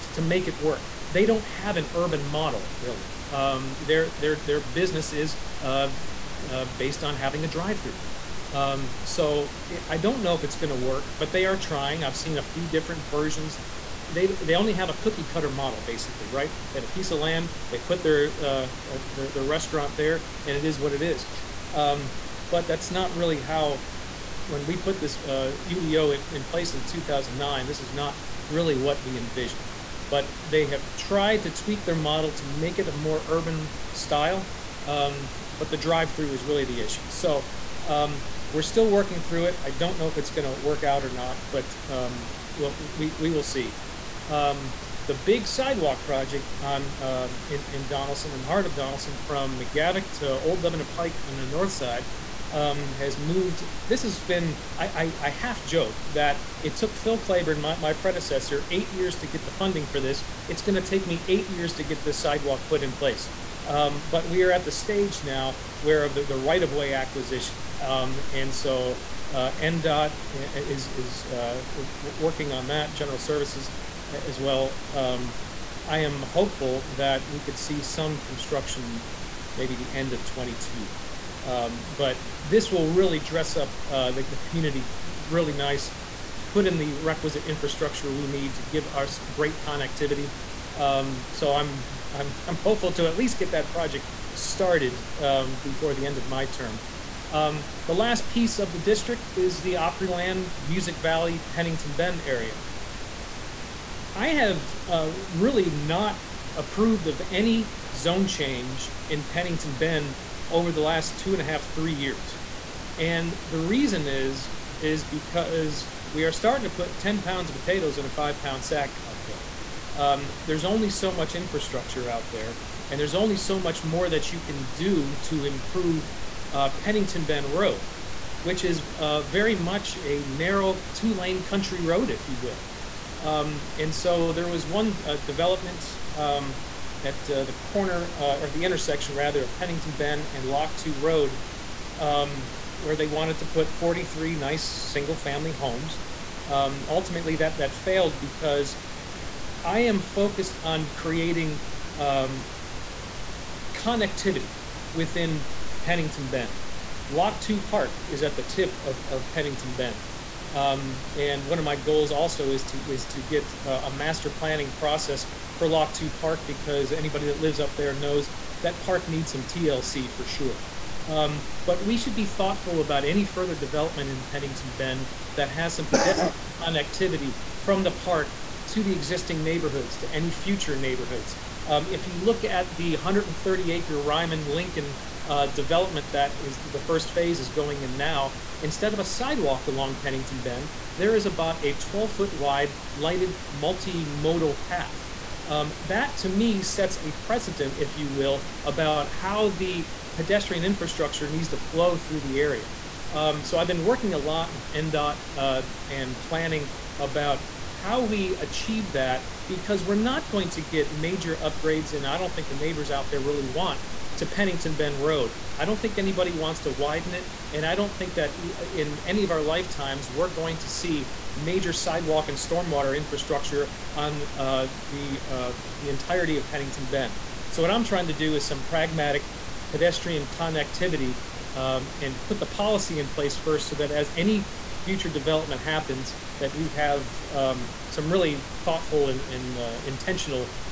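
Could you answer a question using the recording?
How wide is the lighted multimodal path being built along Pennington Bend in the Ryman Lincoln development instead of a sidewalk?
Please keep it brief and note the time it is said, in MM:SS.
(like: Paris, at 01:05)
12 feet, at 03:11.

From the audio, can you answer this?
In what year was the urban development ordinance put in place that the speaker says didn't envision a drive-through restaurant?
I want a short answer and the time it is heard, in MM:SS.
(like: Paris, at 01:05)
2009, at 00:26.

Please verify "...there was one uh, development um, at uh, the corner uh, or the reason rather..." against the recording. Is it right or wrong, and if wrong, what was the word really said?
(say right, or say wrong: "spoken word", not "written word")
wrong: "intersection", not "reason".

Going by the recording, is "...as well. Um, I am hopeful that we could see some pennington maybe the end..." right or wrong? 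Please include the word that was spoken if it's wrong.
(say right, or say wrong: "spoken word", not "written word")
wrong: "construction", not "pennington".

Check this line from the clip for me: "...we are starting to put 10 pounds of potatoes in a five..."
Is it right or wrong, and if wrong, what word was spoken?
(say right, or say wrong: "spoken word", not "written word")
right.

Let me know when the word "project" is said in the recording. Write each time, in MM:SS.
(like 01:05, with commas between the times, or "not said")
00:46, 01:33.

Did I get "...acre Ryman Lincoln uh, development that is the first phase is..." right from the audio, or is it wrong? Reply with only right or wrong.
right.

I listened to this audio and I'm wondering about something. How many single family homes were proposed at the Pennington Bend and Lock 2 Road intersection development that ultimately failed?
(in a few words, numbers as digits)
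43.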